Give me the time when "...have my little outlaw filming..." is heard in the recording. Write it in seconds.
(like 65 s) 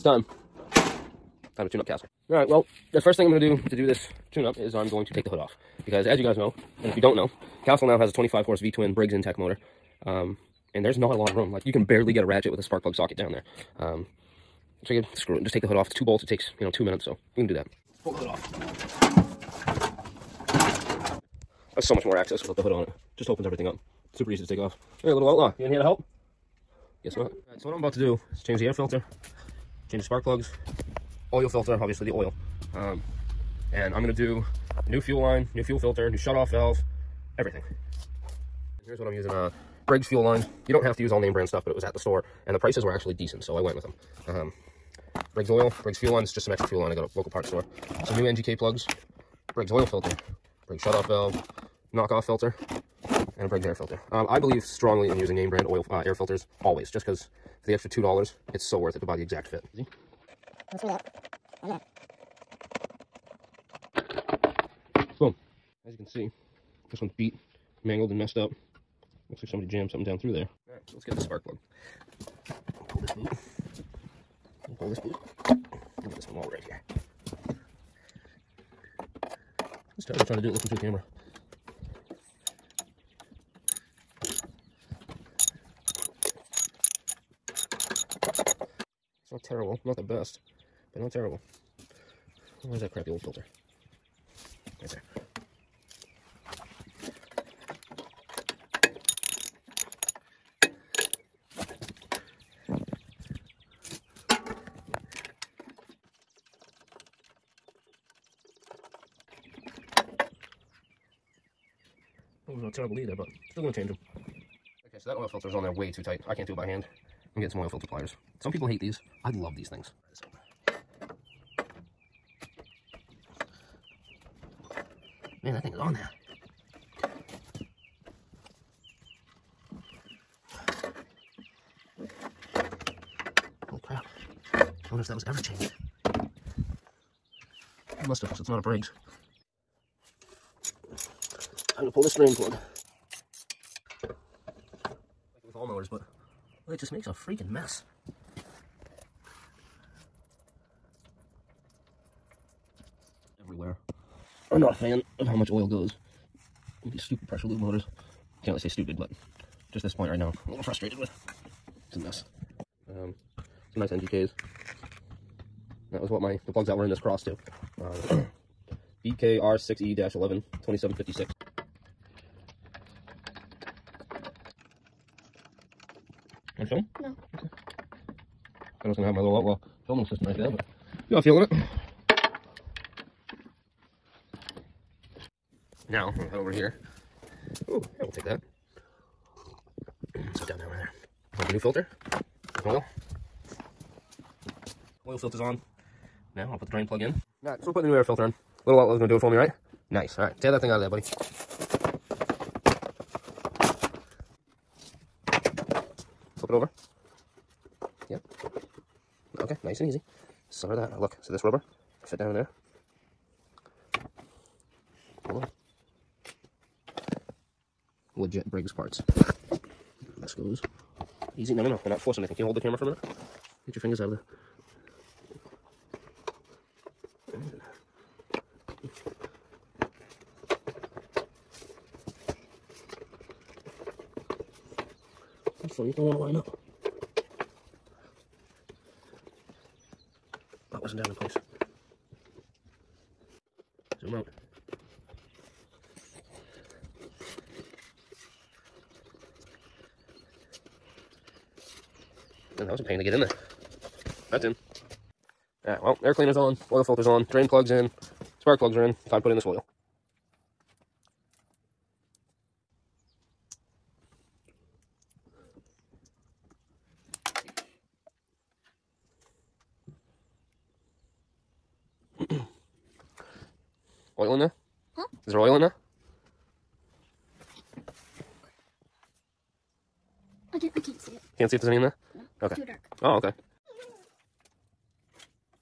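179 s.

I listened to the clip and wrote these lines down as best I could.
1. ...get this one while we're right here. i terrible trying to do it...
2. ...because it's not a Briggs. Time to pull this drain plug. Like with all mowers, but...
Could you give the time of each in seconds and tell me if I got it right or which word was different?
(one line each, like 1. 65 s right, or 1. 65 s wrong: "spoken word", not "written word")
1. 76 s right
2. 138 s right.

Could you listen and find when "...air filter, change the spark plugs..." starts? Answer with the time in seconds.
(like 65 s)
28 s.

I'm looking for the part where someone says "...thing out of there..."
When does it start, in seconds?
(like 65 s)
200 s.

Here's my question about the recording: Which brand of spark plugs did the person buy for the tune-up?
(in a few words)
NGK.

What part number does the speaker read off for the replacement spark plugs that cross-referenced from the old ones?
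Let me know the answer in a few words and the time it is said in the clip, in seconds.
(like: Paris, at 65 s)
BKR6E-11, at 169 s.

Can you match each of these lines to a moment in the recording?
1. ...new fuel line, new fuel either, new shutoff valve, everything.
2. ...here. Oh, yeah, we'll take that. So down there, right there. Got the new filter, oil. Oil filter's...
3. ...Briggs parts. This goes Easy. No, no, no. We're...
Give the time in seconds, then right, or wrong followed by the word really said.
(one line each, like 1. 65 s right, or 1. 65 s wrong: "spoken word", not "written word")
1. 34 s wrong: "filter", not "either"
2. 186 s right
3. 218 s right.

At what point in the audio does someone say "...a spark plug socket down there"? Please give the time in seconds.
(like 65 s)
12 s.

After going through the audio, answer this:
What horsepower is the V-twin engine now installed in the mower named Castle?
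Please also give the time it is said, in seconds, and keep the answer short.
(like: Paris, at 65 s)
25, at 8 s.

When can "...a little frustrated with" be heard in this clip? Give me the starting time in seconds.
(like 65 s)
160 s.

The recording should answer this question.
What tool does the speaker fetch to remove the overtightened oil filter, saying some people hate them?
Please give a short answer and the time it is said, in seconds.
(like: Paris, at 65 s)
Oil filter pliers, at 117 s.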